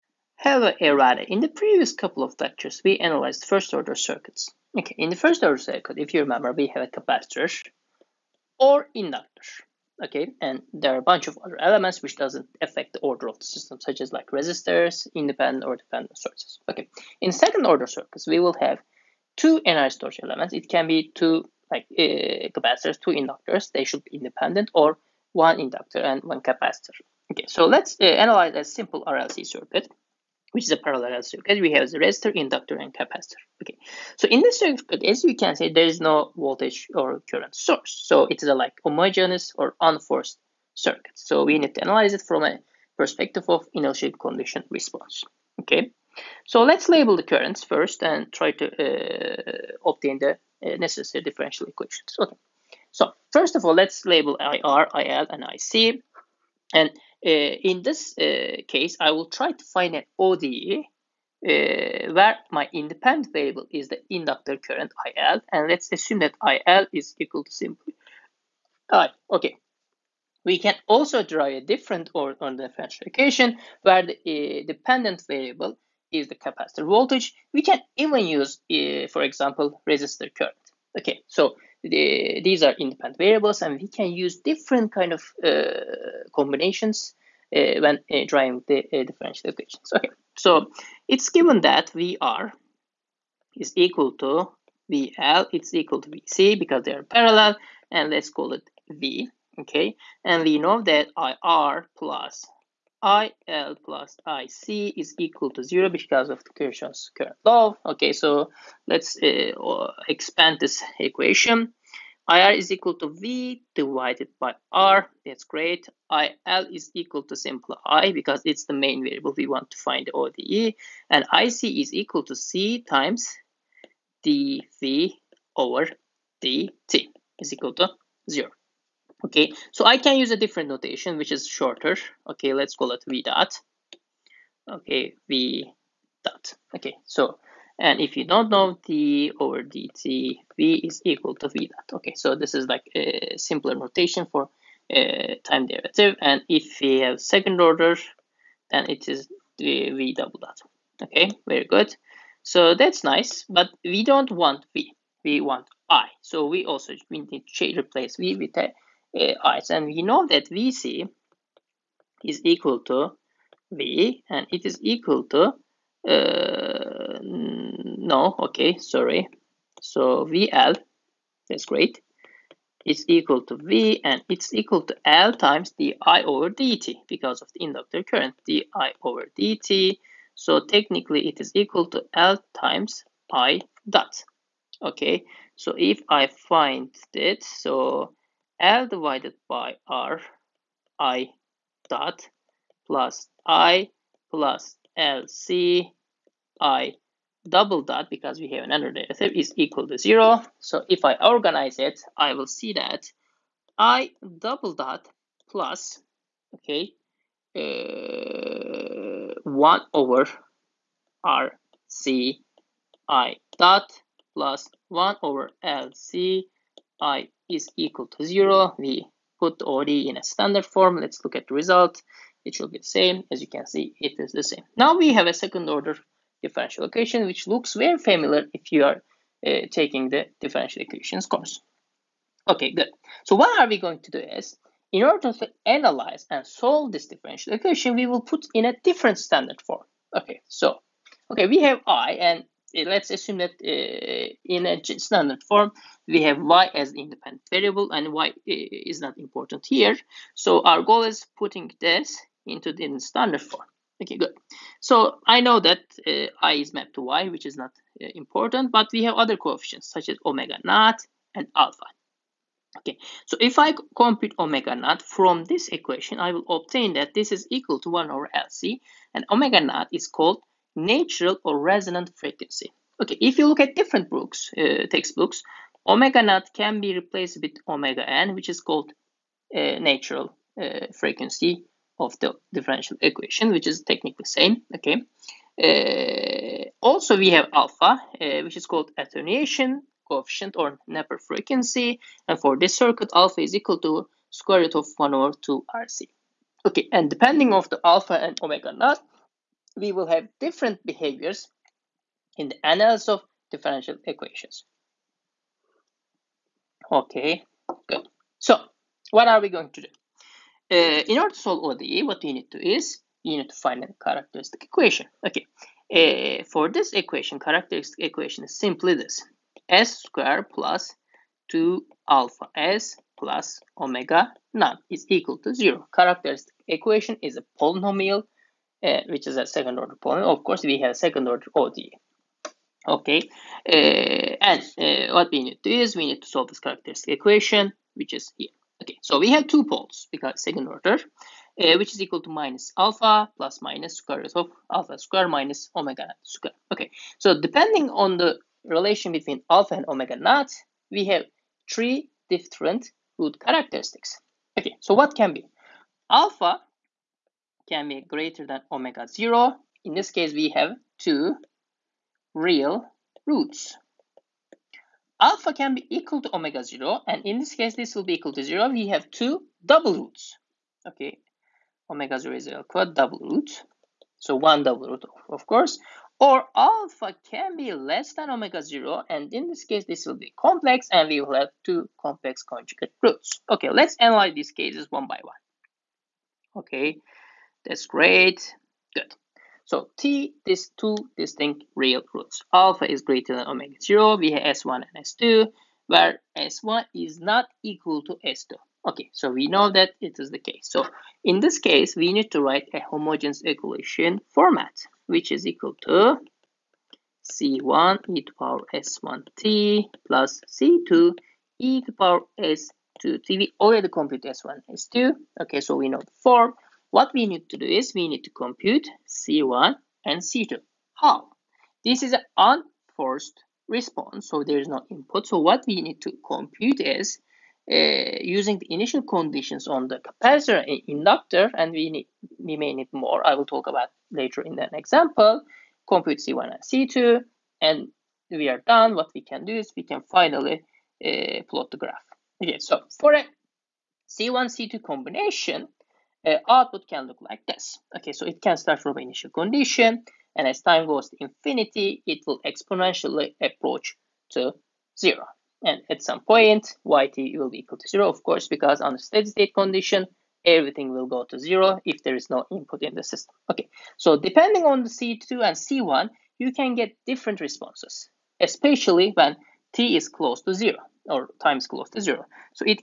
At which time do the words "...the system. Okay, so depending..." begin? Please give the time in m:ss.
7:42.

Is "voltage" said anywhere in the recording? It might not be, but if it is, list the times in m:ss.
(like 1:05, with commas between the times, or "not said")
0:36, 1:16.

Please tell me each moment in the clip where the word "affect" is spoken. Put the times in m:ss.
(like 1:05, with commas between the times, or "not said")
0:12.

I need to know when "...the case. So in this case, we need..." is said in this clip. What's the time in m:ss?
6:40.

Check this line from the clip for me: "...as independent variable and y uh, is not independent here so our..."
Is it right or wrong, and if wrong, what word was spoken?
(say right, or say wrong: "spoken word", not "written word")
wrong: "important", not "independent".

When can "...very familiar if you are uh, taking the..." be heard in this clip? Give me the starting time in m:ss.
3:47.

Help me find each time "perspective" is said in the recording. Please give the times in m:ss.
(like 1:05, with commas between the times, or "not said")
0:42.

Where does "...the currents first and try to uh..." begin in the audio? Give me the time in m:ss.
0:47.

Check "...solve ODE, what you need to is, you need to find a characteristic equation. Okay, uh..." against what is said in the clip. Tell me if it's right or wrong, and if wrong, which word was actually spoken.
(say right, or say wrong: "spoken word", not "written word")
right.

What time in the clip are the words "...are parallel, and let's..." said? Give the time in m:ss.
1:36.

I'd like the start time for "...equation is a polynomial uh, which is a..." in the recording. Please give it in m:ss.
5:26.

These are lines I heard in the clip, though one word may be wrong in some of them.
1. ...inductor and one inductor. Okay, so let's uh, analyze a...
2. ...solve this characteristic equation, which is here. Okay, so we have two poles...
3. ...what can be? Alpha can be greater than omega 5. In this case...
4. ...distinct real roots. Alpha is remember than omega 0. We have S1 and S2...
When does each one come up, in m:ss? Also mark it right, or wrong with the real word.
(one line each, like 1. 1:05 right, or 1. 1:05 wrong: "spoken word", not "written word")
1. 0:25 wrong: "capacitor", not "inductor"
2. 5:36 right
3. 5:54 wrong: "0", not "5"
4. 6:31 wrong: "greater", not "remember".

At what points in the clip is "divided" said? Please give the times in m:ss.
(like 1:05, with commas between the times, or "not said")
1:53, 3:08.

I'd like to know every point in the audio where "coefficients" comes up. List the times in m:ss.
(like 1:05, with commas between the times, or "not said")
4:19, 4:50.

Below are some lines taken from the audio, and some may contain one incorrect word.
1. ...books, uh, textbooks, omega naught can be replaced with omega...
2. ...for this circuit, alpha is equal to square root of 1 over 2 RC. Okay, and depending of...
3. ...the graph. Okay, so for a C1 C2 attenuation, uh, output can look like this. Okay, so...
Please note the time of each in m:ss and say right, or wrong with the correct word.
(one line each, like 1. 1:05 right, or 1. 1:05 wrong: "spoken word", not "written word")
1. 4:34 right
2. 4:52 right
3. 7:21 wrong: "combination", not "attenuation".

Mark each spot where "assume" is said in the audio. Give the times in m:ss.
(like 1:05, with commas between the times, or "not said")
1:05, 4:03.